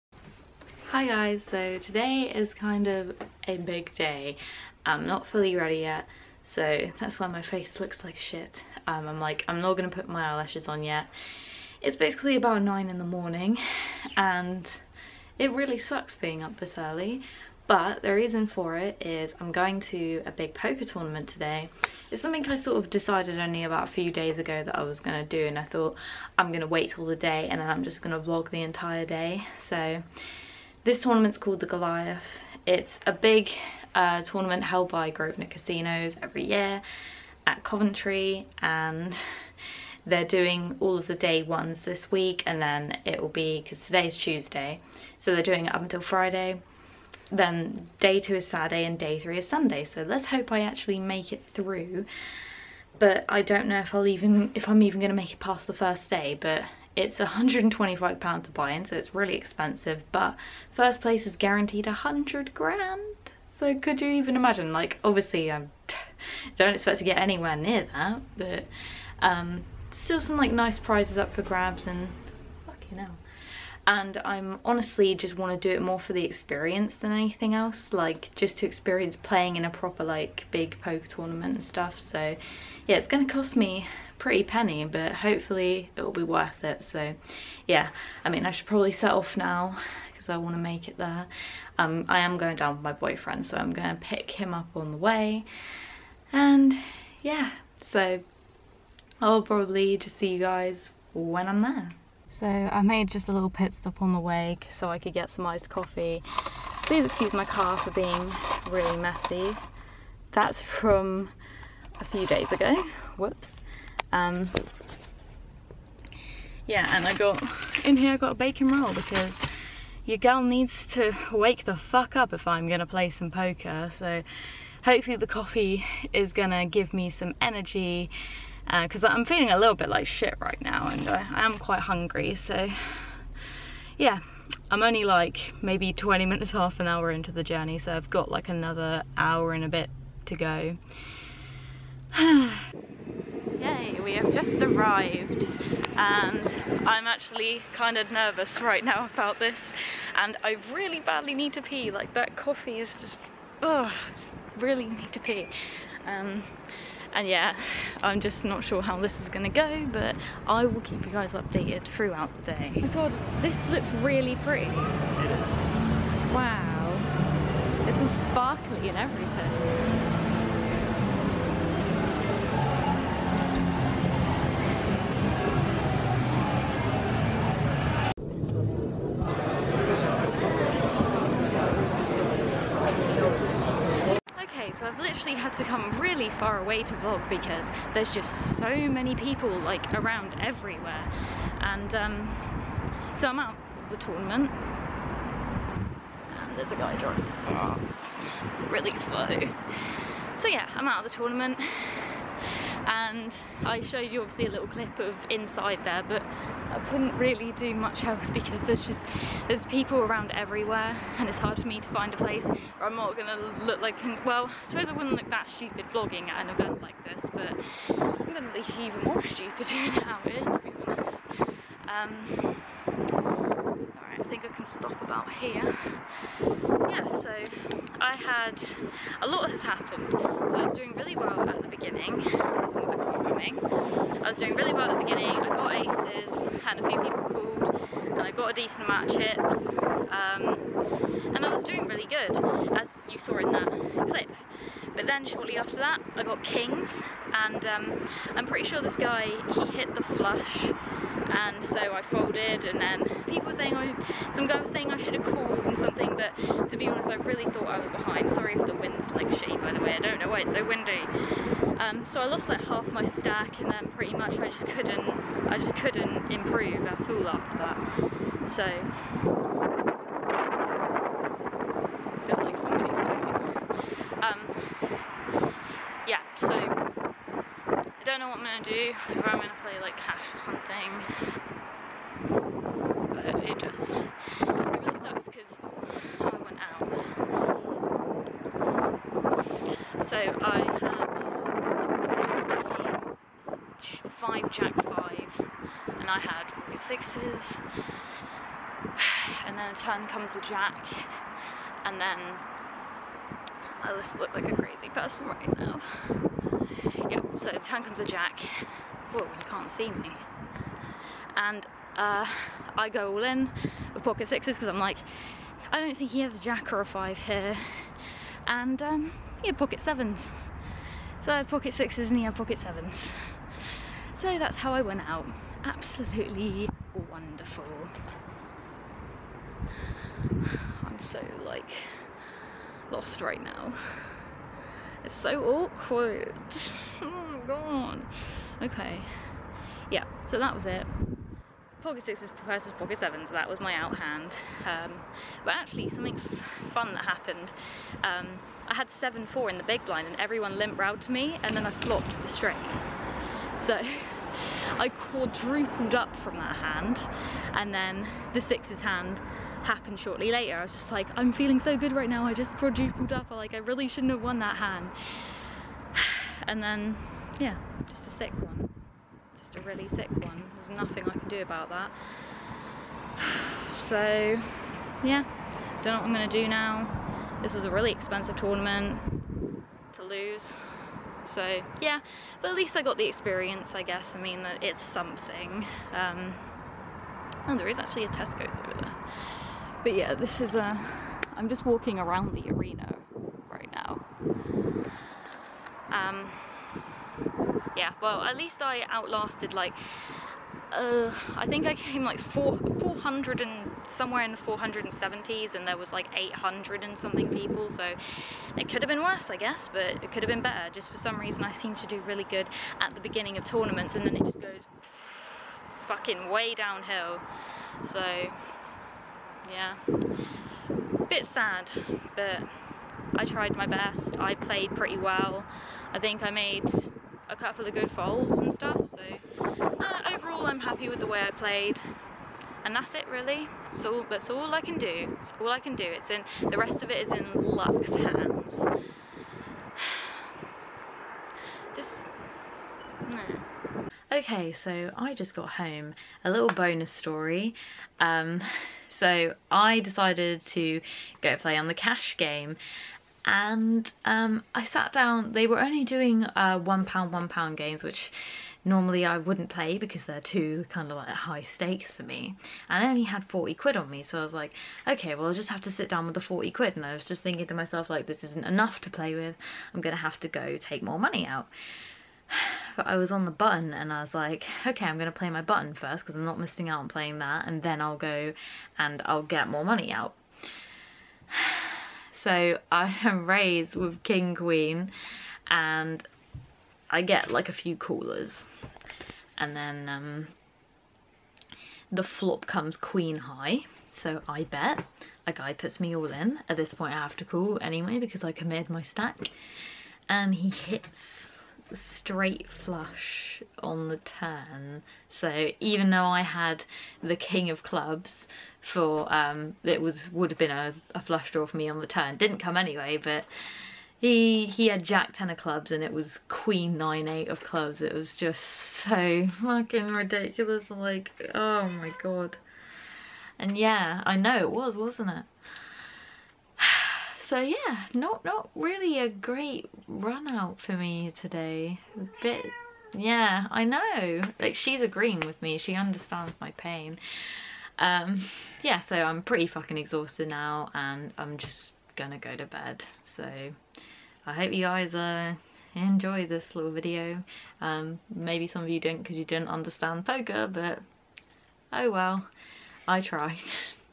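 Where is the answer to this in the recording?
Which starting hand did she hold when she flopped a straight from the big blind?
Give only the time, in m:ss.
5:49.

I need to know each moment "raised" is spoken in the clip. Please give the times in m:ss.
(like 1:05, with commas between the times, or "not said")
8:03.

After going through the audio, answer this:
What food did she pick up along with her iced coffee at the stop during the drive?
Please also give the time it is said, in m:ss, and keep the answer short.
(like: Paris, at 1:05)
bacon roll, at 1:58.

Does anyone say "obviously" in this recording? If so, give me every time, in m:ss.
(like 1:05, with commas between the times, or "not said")
1:05, 3:24.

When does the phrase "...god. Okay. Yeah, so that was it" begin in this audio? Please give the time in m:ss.
5:37.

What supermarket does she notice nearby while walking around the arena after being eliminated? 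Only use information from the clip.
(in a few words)
Tesco's.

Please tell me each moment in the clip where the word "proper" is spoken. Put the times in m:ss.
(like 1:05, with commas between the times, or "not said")
1:19.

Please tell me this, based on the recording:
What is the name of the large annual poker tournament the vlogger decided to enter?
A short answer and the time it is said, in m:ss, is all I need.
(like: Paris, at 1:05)
The Goliath, at 0:31.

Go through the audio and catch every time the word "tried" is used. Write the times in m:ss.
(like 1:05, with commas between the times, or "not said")
7:03, 9:12.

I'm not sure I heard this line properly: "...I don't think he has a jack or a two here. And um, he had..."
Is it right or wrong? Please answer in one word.
wrong.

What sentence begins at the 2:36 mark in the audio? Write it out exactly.
Um, and yeah, I'm just not sure how this is gonna go, but I will keep you guys updated throughout the day.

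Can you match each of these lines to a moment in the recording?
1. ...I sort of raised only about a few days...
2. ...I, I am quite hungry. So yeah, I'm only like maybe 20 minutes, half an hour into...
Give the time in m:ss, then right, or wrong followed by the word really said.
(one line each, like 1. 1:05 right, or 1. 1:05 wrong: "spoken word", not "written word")
1. 0:22 wrong: "decided", not "raised"
2. 2:11 right.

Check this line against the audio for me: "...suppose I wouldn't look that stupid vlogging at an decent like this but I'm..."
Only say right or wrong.
wrong.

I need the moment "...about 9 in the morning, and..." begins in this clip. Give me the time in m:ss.
0:12.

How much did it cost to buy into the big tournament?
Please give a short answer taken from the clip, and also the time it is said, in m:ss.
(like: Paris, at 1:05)
£125, at 0:57.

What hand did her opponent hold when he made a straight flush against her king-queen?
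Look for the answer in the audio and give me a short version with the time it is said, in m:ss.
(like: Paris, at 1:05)
jack ten of clubs, at 8:34.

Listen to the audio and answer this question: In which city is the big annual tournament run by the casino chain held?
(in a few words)
Coventry.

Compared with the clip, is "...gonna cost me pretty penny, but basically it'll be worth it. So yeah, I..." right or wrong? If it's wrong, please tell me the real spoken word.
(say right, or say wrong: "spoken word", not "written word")
wrong: "hopefully", not "basically".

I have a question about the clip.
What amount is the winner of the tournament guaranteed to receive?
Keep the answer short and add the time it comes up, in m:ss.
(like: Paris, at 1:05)
100 grand, at 1:01.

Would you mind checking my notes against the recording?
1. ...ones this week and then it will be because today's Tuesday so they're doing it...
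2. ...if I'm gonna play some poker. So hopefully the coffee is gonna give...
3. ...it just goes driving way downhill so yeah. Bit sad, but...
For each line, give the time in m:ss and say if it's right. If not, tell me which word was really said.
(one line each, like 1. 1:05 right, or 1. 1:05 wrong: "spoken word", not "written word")
1. 0:41 right
2. 2:02 right
3. 6:54 wrong: "fucking", not "driving".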